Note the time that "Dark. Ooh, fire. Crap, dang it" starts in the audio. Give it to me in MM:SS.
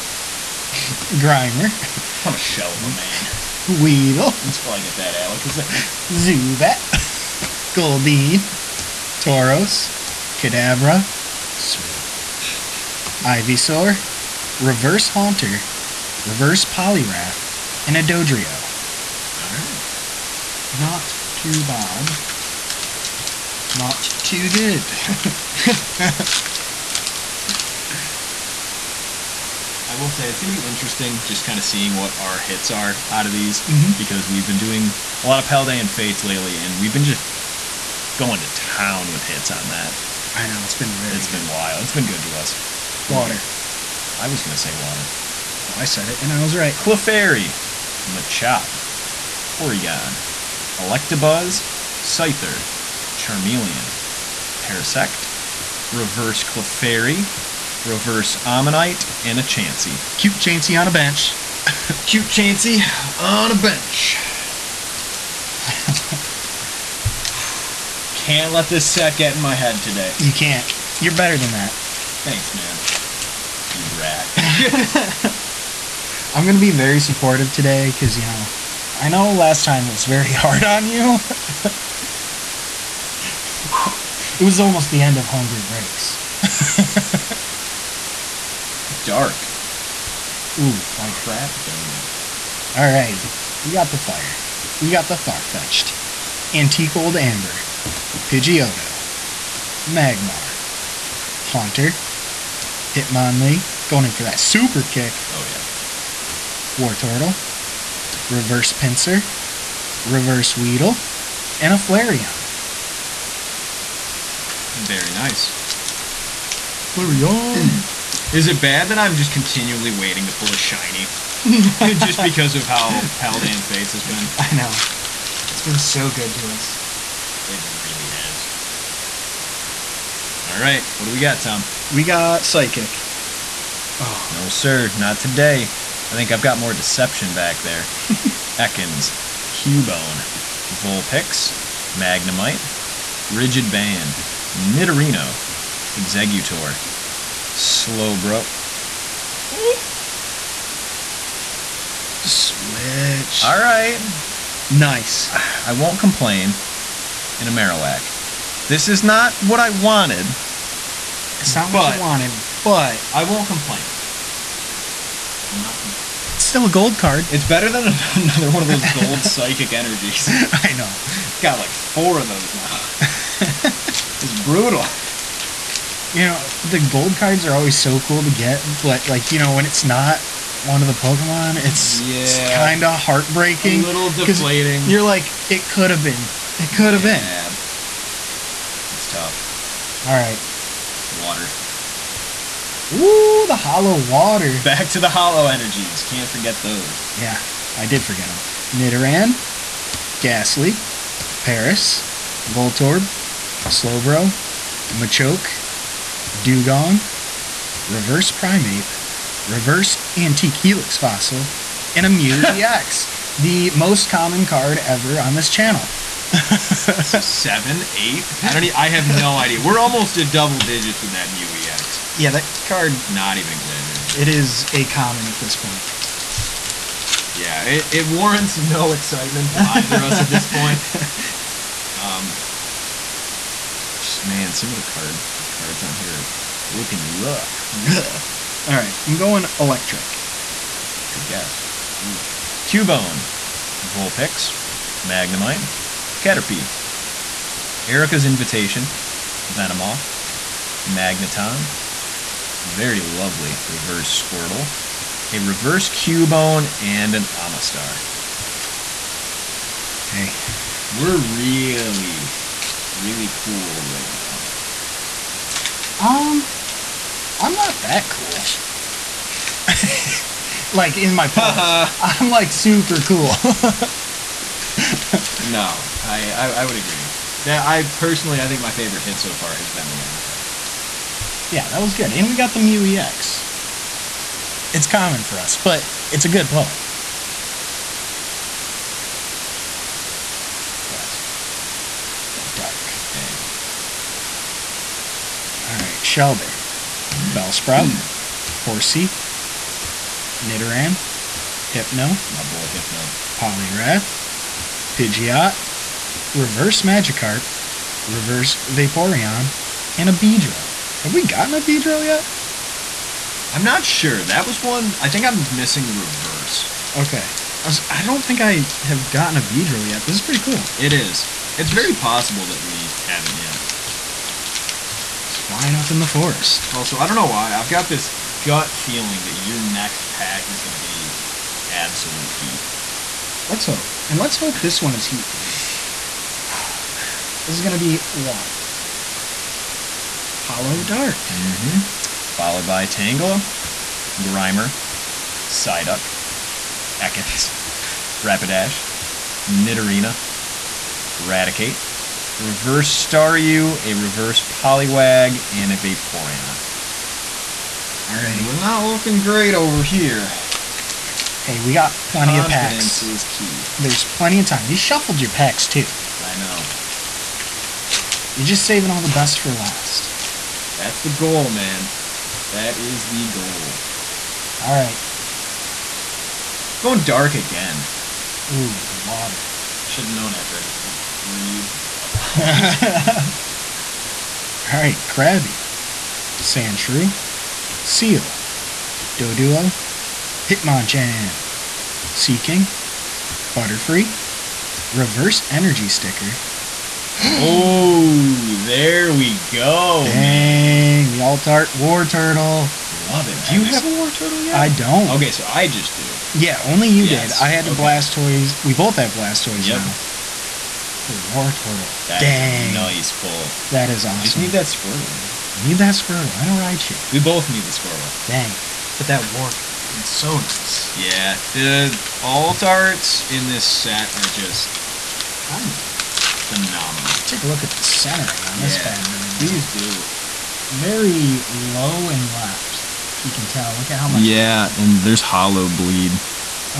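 01:29.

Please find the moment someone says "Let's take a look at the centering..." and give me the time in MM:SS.
07:07.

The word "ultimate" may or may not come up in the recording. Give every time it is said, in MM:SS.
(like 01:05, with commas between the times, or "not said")
not said.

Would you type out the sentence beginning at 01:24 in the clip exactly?
it was almost the end of homebrew breaks.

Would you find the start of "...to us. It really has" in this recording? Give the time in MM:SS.
02:06.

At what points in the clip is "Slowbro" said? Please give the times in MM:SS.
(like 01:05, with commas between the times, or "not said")
02:27, 03:23.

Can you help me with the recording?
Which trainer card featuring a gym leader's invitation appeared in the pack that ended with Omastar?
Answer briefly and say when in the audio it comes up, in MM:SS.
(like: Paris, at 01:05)
Erica's Invitation, at 04:07.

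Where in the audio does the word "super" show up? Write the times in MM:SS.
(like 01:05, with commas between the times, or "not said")
01:44, 04:32.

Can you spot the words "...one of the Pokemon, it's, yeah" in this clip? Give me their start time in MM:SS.
03:00.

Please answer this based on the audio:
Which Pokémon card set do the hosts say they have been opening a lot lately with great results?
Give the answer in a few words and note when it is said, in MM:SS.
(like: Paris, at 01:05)
Paldean Fates, at 00:35.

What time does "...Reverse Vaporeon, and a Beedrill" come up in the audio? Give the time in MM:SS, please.
05:08.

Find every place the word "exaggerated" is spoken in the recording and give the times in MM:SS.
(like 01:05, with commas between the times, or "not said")
03:43.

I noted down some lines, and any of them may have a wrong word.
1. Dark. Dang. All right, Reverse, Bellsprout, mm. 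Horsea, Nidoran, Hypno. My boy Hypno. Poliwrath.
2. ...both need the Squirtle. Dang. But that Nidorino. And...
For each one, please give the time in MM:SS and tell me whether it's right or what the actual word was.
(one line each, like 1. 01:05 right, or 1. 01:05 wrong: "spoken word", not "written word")
1. 04:52 wrong: "Shellder", not "Reverse"
2. 06:57 wrong: "Wartortle", not "Nidorino".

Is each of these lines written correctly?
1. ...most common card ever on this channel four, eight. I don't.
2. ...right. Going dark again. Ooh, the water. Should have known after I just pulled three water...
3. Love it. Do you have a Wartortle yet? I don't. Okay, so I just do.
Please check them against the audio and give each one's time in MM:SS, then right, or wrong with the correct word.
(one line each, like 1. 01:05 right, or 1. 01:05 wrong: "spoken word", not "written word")
1. 03:33 wrong: "seven", not "four"
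2. 06:14 right
3. 06:42 right.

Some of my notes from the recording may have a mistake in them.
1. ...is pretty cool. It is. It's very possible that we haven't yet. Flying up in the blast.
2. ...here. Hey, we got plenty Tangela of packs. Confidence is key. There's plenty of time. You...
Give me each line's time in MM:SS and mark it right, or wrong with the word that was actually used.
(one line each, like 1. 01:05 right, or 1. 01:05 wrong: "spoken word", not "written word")
1. 05:20 wrong: "forest", not "blast"
2. 05:59 wrong: "Confidence", not "Tangela".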